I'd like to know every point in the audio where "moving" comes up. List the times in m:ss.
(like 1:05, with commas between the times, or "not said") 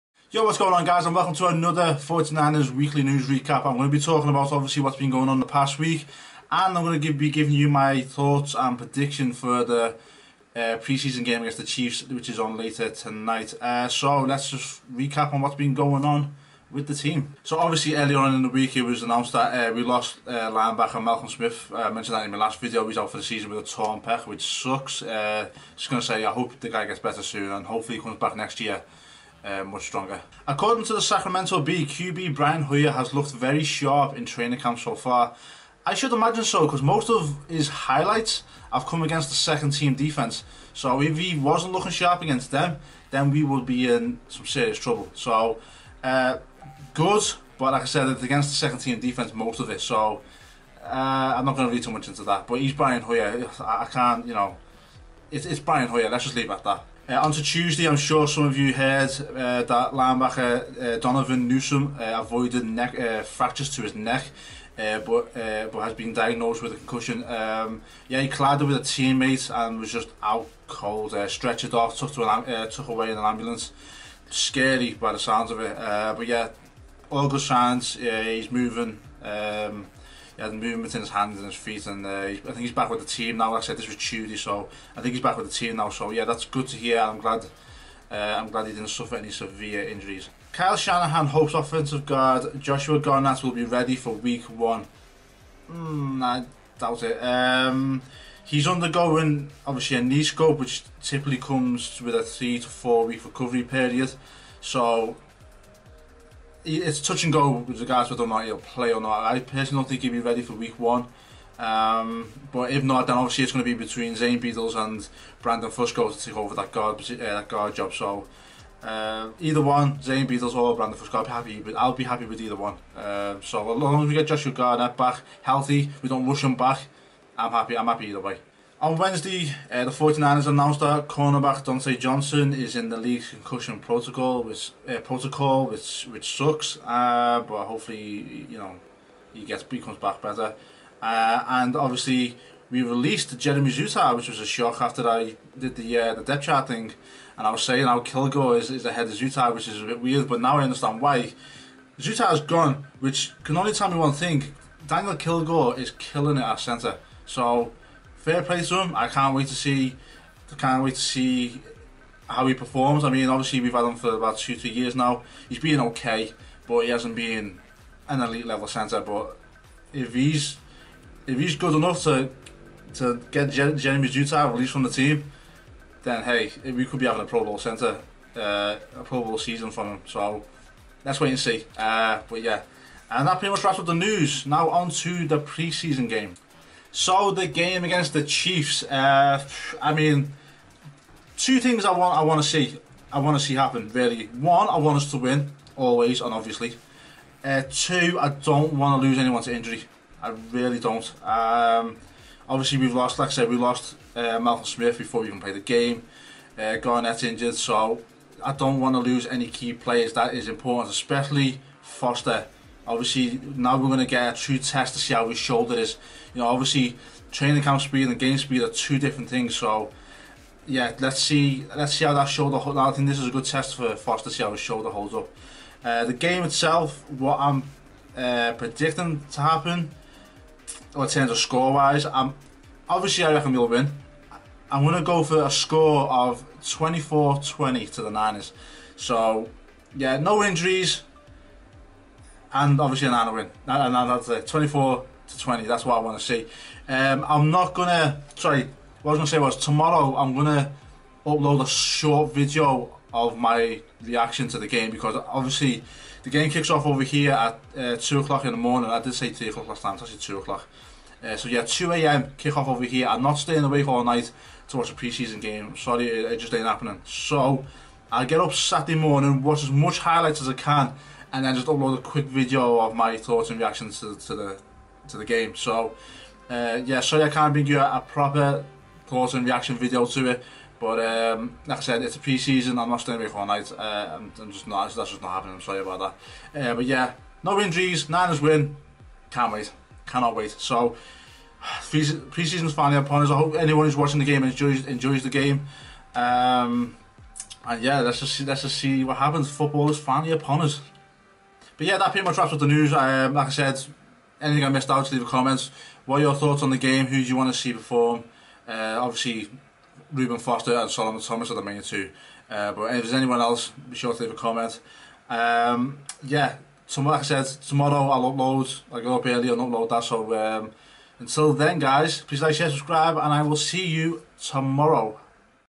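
1:18.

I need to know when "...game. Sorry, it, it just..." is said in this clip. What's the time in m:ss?
4:25.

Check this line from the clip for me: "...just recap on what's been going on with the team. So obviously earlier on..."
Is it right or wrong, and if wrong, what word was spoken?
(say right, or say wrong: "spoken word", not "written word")
right.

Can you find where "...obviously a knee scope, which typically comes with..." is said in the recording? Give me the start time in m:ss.
1:39.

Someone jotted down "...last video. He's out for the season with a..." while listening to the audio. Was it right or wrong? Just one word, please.
right.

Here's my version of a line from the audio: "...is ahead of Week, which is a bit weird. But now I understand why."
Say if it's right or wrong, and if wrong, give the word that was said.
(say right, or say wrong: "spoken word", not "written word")
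wrong: "Zuttah", not "Week".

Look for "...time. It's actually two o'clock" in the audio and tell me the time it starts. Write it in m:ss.
4:19.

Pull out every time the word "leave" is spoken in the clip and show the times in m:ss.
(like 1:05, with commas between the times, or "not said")
0:56, 5:05, 5:14.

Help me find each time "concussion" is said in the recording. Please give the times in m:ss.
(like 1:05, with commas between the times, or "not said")
1:06, 2:13.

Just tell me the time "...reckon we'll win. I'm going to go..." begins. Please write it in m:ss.
3:53.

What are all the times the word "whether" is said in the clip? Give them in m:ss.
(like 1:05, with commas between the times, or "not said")
1:48.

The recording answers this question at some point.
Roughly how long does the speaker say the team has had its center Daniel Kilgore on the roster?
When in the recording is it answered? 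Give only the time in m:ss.
2:44.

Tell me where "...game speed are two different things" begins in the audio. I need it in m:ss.
3:38.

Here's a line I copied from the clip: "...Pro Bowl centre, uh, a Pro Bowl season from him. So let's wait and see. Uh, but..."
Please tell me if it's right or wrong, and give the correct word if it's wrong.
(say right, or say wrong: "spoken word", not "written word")
right.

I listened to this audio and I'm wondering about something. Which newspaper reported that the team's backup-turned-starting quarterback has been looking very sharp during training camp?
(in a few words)
Sacramento Bee.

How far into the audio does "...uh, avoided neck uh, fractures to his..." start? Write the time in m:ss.
1:01.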